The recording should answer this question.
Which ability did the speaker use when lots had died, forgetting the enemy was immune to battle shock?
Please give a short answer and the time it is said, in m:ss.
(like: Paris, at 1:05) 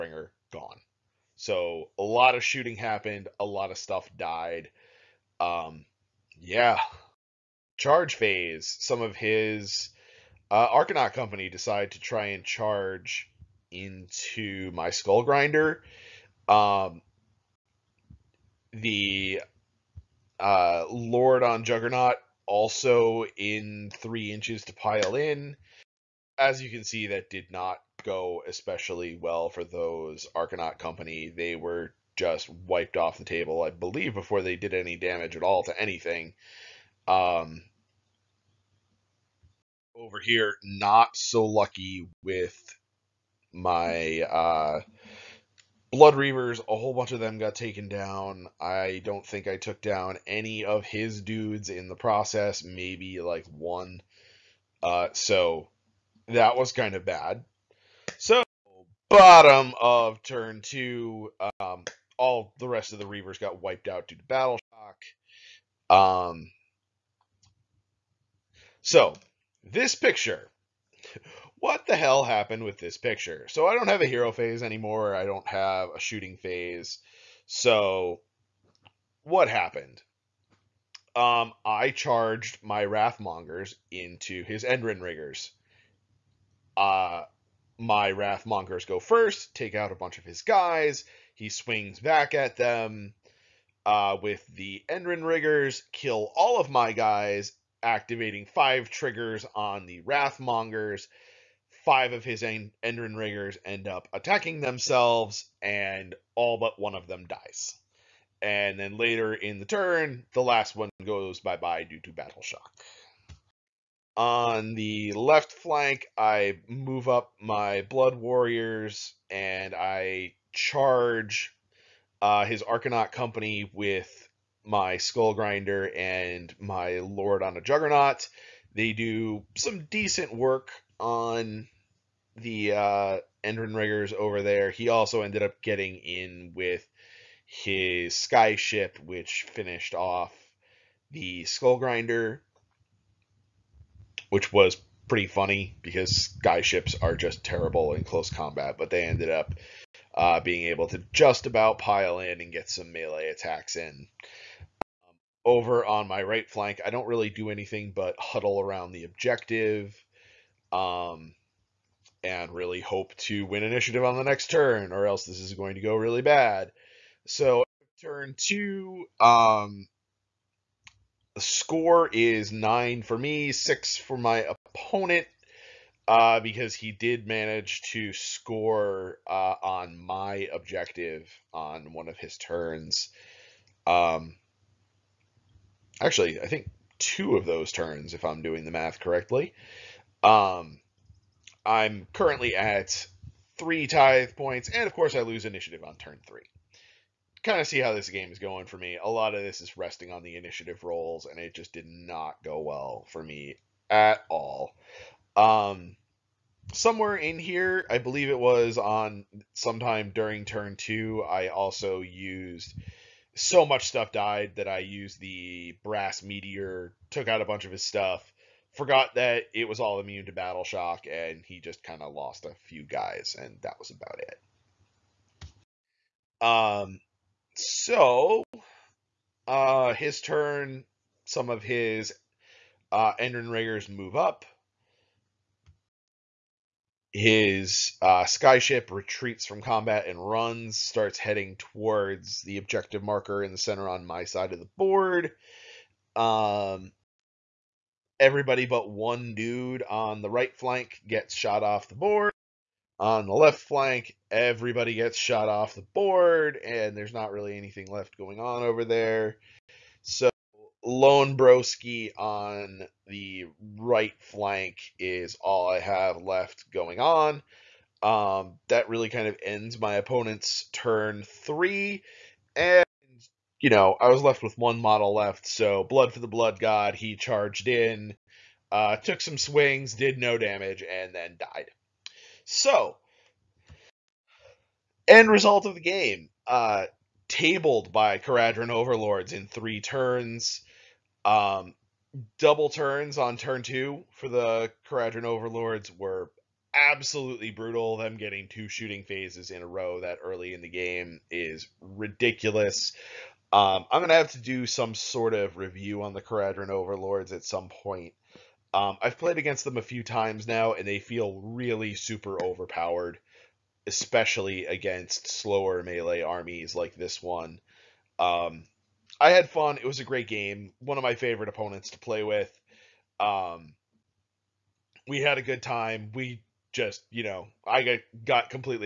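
Brass meteor, at 3:35.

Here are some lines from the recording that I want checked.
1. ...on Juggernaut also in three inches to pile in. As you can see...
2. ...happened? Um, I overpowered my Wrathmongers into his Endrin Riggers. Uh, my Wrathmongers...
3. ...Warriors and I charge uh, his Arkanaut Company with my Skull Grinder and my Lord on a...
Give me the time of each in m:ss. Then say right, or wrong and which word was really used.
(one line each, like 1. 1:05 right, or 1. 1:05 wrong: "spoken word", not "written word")
1. 0:21 right
2. 1:19 wrong: "charged", not "overpowered"
3. 1:58 right.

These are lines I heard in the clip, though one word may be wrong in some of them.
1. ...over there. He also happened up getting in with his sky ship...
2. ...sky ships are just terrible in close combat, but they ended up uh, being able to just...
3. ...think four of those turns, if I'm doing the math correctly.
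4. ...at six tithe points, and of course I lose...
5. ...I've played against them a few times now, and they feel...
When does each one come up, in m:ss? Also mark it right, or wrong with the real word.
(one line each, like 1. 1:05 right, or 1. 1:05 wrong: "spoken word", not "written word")
1. 2:14 wrong: "ended", not "happened"
2. 2:26 right
3. 3:06 wrong: "two", not "four"
4. 3:12 wrong: "three", not "six"
5. 5:09 right.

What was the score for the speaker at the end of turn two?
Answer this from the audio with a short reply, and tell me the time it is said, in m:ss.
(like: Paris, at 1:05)
9, at 2:52.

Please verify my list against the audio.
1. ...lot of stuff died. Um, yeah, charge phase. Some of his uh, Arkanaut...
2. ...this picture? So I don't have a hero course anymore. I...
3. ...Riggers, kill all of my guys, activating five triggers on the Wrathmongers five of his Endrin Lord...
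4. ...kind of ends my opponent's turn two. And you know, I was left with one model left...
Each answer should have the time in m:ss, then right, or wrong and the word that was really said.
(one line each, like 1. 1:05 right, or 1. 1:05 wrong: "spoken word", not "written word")
1. 0:03 right
2. 1:12 wrong: "phase", not "course"
3. 1:35 wrong: "Enderin", not "Lord"
4. 4:29 wrong: "three", not "two".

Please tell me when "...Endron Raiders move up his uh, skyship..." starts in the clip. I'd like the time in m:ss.
3:53.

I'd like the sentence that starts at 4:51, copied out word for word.
Um, double turns on turn two for the Kharadron Overlords were absolutely brutal.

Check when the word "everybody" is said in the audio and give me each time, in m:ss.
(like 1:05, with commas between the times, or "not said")
4:08, 4:14.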